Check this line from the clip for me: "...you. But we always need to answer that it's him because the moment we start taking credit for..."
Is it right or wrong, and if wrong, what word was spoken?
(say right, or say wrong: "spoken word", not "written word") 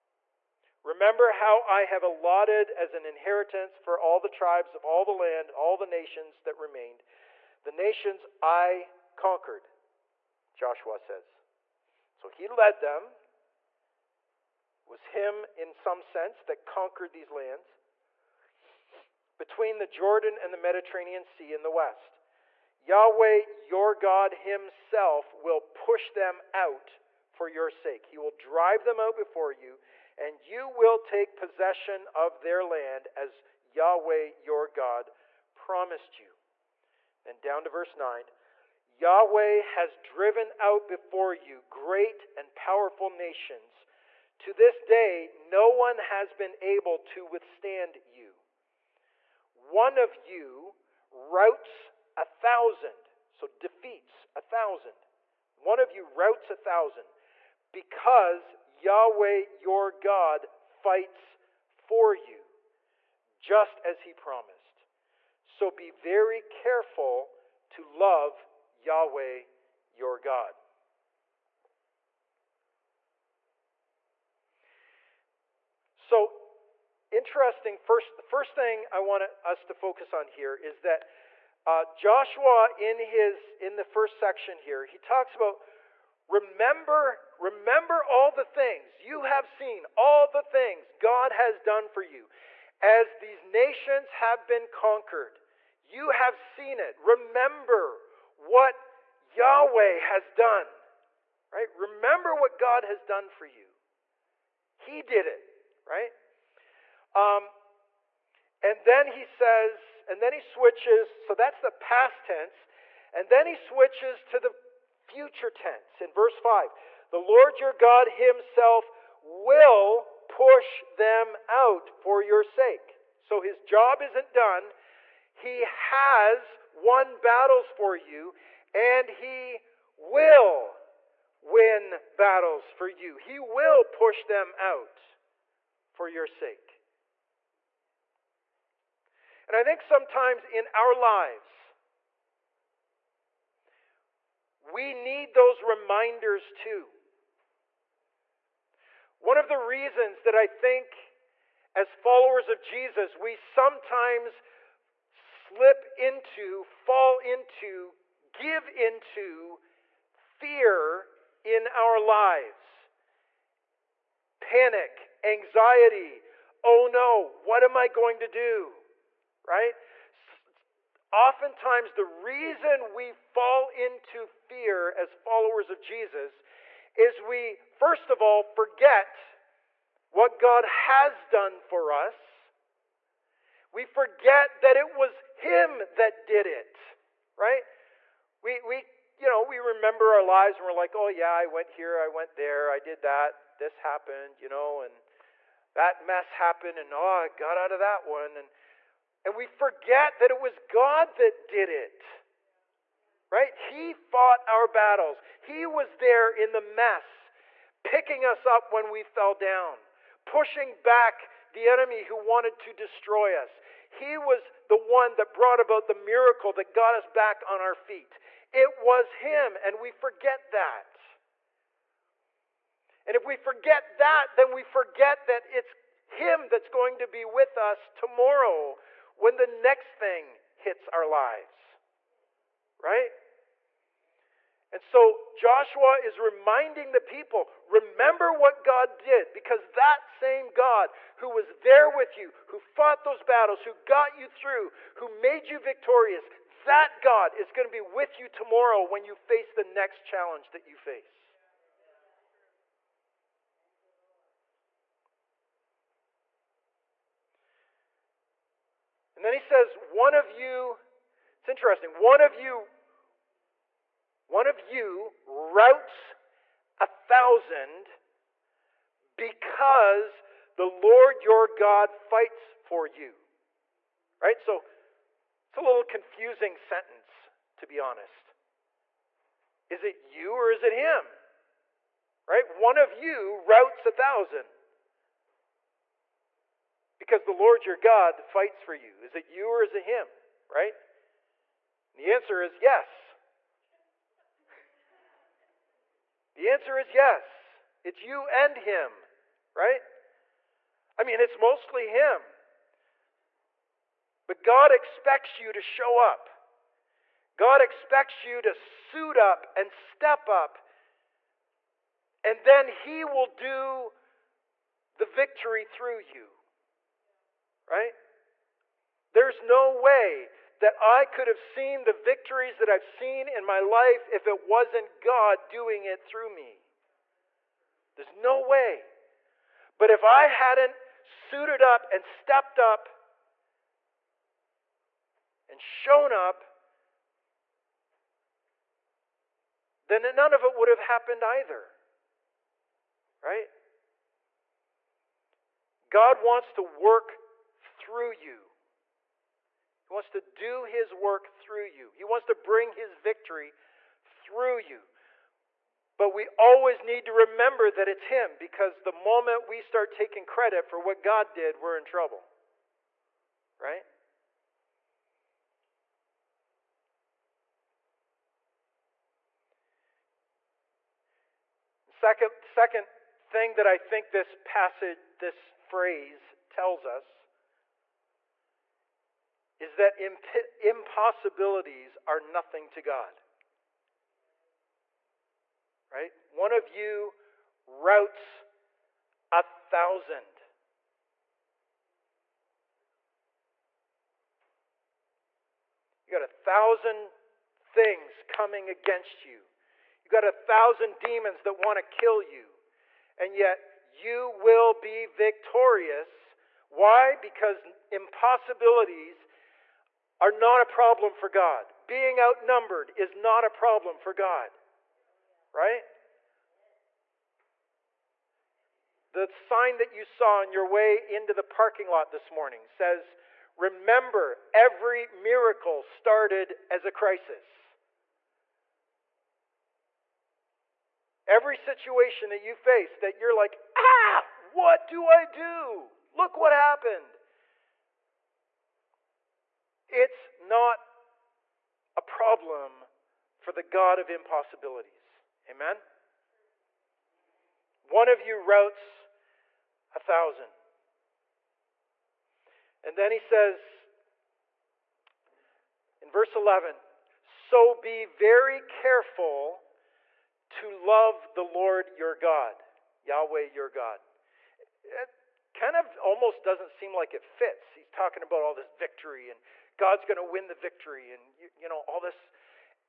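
wrong: "remember", not "answer".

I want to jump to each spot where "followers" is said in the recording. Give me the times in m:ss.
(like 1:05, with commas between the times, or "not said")
2:31, 2:55.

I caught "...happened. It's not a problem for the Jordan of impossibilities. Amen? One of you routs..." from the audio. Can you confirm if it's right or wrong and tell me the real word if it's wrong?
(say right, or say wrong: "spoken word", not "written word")
wrong: "God", not "Jordan".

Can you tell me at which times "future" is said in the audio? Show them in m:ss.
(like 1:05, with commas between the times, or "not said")
1:55.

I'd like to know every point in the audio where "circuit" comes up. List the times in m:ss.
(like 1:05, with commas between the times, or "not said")
not said.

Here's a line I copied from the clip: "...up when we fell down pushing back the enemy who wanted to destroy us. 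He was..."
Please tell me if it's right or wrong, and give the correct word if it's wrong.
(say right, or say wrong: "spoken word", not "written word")
right.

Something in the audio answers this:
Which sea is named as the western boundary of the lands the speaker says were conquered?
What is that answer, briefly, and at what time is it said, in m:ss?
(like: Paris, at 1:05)
Mediterranean Sea, at 0:20.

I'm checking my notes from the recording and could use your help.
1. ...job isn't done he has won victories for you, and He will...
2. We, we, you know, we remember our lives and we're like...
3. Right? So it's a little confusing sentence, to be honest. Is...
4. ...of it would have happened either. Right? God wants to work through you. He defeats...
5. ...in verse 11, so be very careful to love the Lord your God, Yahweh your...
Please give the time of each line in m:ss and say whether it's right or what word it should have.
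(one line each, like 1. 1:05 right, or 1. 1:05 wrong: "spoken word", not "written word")
1. 2:03 wrong: "battles", not "victories"
2. 3:08 right
3. 4:34 right
4. 5:40 wrong: "wants", not "defeats"
5. 7:36 right.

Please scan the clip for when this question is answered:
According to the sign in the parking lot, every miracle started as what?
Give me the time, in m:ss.
7:06.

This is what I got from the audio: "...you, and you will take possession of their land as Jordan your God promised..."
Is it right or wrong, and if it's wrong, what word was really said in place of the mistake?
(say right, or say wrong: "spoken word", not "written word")
wrong: "Yahweh", not "Jordan".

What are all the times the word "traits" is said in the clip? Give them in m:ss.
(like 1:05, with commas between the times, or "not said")
not said.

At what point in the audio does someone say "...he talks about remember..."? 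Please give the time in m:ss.
1:24.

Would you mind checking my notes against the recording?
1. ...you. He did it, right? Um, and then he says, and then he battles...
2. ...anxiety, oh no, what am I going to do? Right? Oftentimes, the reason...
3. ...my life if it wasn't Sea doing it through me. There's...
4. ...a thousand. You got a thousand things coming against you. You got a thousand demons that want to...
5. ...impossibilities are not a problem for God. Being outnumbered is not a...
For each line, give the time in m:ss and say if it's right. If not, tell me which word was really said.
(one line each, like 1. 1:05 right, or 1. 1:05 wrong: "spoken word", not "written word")
1. 1:43 wrong: "switches", not "battles"
2. 2:45 right
3. 5:23 wrong: "God", not "Sea"
4. 6:29 right
5. 6:47 right.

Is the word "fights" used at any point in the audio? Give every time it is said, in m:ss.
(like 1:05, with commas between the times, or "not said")
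1:00, 4:32, 4:48.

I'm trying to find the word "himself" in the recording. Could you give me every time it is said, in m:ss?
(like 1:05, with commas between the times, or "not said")
0:24, 1:58.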